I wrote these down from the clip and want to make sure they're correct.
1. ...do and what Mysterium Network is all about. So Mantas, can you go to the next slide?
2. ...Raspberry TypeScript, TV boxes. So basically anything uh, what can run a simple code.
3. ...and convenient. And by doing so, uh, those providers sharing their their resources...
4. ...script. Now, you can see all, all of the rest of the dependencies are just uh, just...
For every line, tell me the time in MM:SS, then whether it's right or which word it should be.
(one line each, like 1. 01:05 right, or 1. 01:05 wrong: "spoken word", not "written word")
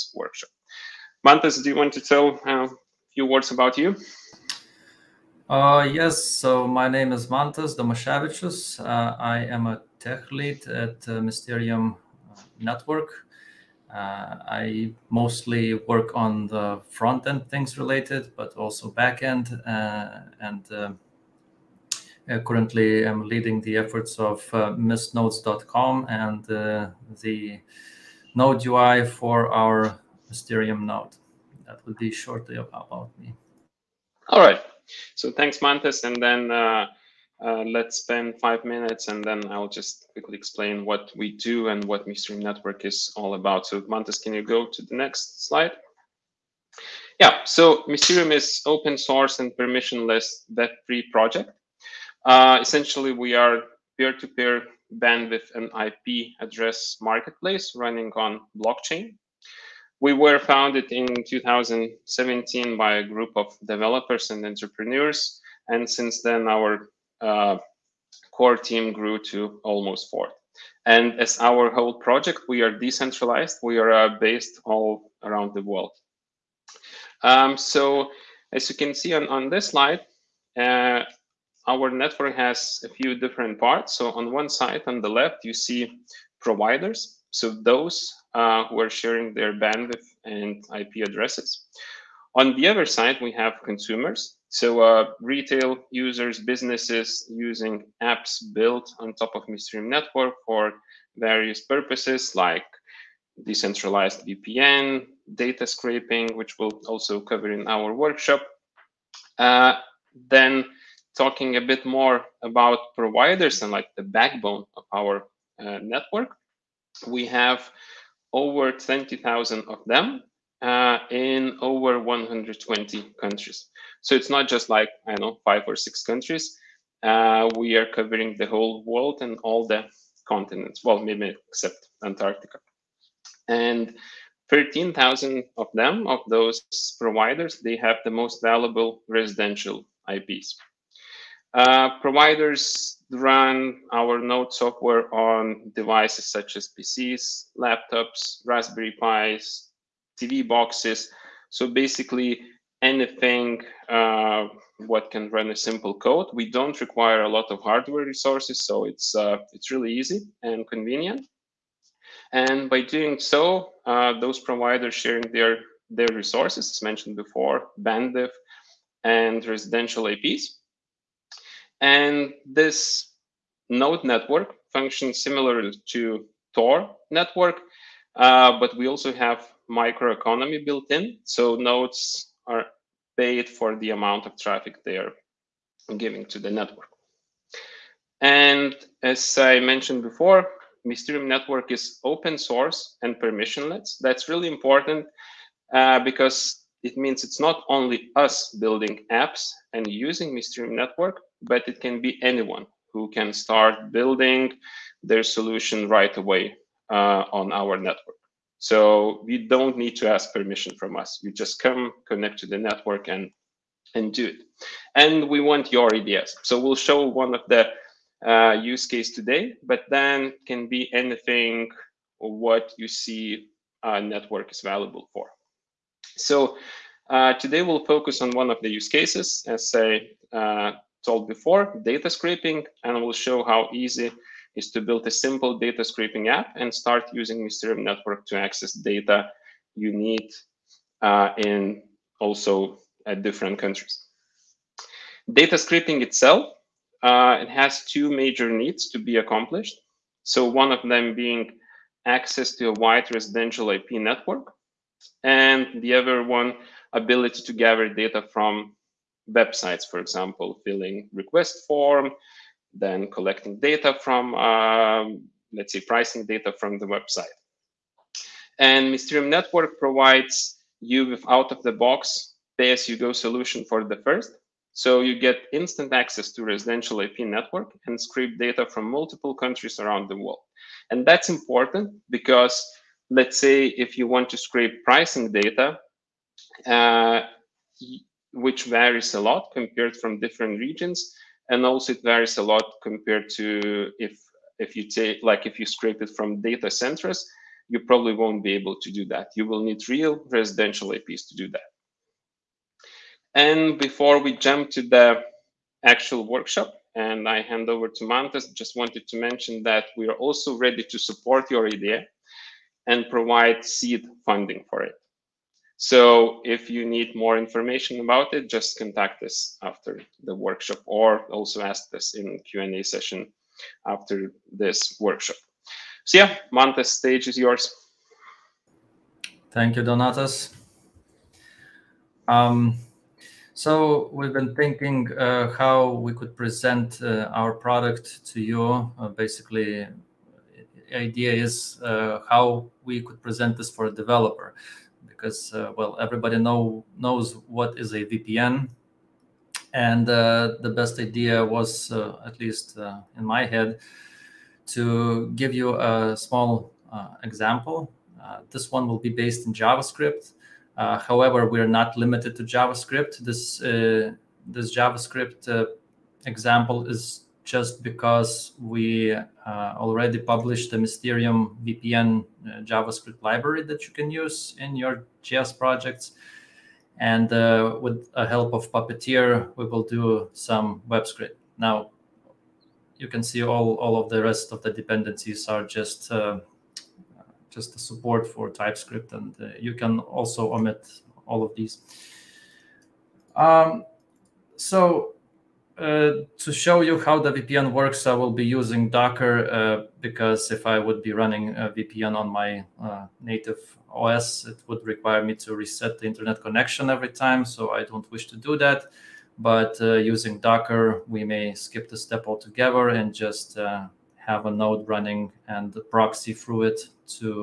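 1. 00:41 right
2. 02:28 wrong: "Pis", not "TypeScript"
3. 02:40 right
4. 06:21 right.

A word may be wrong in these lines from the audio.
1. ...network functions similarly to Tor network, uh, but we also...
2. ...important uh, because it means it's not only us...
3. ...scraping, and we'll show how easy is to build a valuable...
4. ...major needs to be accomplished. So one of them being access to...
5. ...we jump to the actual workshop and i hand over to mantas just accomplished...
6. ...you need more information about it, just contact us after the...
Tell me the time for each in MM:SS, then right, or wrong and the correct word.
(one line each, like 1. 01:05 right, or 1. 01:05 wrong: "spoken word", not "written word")
1. 02:54 right
2. 03:14 right
3. 03:52 wrong: "simple", not "valuable"
4. 04:08 right
5. 05:04 wrong: "wanted", not "accomplished"
6. 05:16 right.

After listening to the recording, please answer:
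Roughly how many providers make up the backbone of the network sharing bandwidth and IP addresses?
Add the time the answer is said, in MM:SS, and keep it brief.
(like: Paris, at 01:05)
over 20,000, at 01:58.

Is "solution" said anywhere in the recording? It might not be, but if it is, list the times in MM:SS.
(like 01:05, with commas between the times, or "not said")
03:25, 04:33.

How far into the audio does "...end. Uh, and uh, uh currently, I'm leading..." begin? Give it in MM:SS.
00:19.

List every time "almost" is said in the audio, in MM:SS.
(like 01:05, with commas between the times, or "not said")
01:09.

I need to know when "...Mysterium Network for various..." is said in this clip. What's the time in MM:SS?
01:39.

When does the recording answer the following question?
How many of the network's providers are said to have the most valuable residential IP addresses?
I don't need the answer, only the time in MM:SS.
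02:14.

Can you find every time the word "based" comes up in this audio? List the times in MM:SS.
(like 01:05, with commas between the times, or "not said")
01:14, 05:59.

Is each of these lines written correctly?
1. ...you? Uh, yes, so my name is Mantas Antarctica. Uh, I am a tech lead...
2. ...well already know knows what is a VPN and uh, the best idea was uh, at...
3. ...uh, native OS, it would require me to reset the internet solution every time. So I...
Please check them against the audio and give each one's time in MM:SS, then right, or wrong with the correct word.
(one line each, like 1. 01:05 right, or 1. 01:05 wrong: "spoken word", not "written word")
1. 00:03 wrong: "Domashevichus", not "Antarctica"
2. 05:45 wrong: "everybody", not "already"
3. 06:42 wrong: "connection", not "solution".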